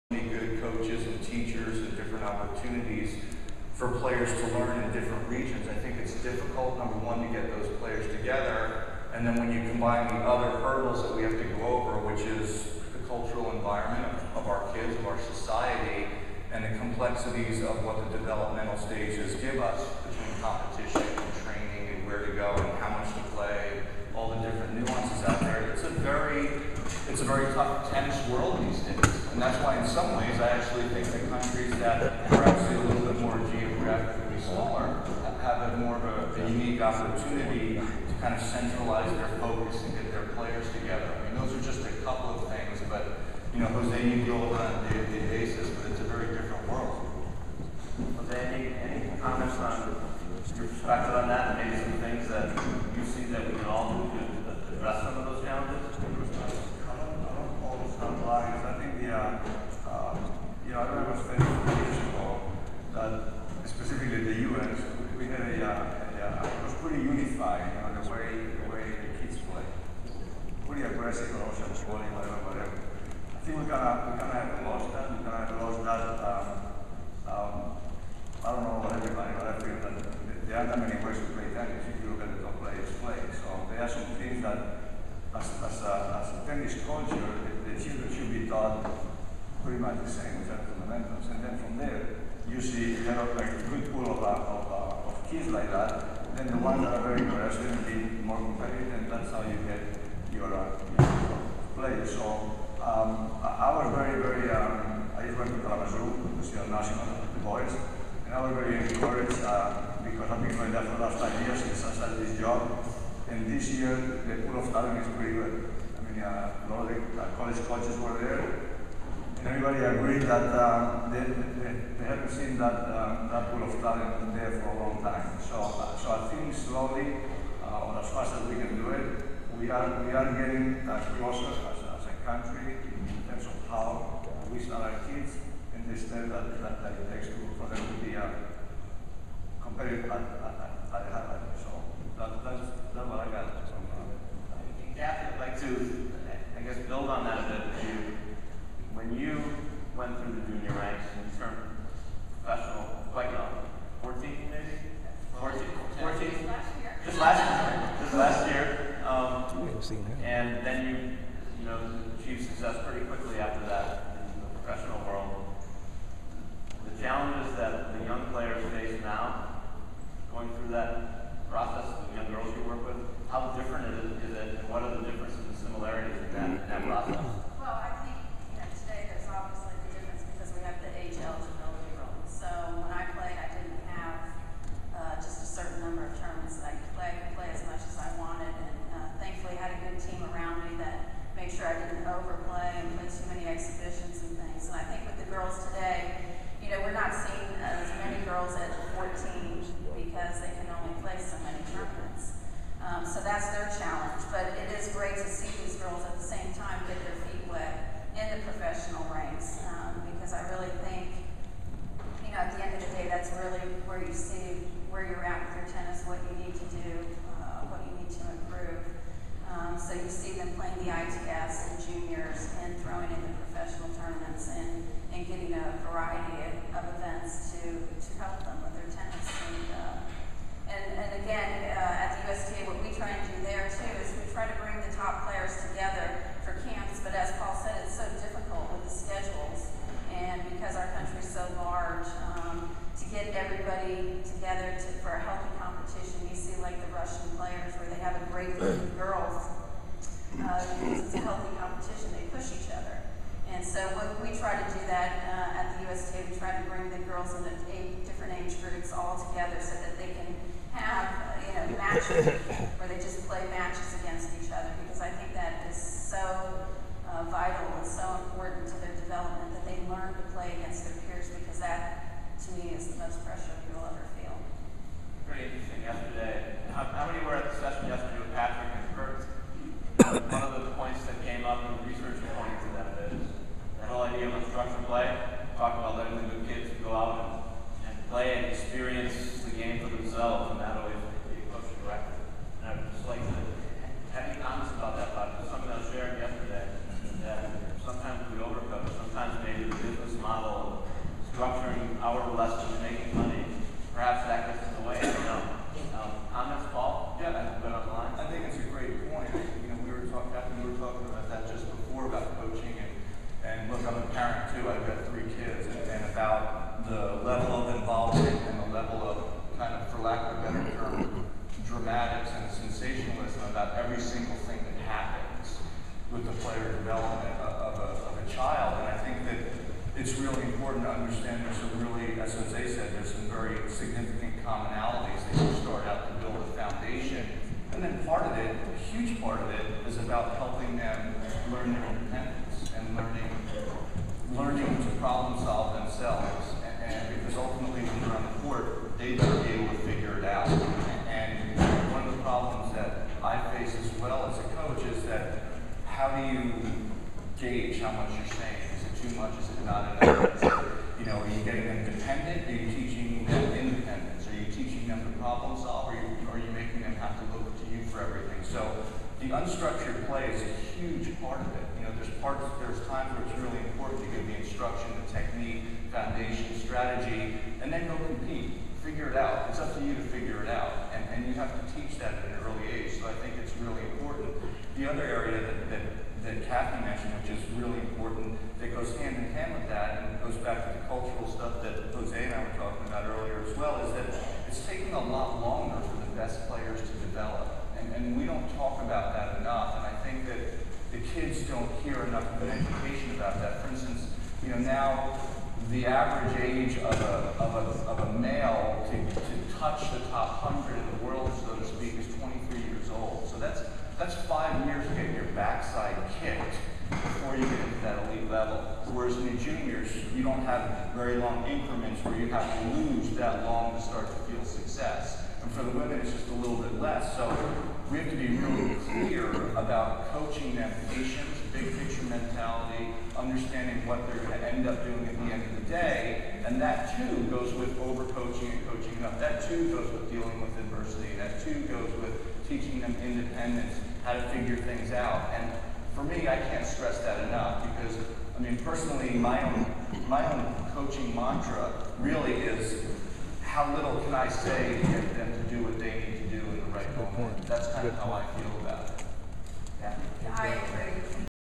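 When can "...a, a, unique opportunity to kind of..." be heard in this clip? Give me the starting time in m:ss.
0:36.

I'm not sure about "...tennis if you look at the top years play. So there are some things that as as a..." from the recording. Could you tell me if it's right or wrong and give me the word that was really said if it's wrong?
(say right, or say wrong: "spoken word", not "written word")
wrong: "players", not "years".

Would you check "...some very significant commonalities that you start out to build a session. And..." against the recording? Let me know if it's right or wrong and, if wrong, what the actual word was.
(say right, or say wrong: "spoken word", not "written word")
wrong: "foundation", not "session".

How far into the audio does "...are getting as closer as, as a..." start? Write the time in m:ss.
2:10.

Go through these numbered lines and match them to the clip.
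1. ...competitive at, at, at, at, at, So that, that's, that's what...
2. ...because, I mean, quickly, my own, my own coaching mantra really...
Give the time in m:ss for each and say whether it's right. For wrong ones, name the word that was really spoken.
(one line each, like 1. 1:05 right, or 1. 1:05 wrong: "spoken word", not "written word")
1. 2:19 right
2. 7:27 wrong: "personally", not "quickly".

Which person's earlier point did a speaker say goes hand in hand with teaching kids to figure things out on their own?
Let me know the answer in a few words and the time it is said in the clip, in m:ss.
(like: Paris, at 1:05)
Kathy, at 6:26.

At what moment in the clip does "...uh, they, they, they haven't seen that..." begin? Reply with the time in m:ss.
2:00.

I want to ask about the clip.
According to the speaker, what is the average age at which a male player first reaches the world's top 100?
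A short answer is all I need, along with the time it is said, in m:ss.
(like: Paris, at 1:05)
23, at 6:52.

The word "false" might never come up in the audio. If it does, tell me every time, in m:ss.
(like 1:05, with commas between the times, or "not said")
not said.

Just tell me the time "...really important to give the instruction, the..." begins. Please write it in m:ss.
6:13.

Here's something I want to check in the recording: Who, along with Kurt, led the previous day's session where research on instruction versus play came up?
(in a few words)
Patrick.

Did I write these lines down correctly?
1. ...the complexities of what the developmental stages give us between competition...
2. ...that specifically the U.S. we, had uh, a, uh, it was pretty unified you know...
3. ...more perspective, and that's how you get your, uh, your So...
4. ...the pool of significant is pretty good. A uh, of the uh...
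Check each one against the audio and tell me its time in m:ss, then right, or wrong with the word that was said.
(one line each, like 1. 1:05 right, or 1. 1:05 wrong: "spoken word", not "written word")
1. 0:16 right
2. 1:02 right
3. 1:38 wrong: "competitive", not "perspective"
4. 1:54 wrong: "talent", not "significant".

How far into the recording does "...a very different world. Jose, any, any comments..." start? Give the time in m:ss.
0:46.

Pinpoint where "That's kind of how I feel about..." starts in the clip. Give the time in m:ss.
7:37.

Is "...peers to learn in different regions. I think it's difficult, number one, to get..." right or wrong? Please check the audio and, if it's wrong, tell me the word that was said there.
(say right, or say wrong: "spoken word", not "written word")
wrong: "players", not "peers".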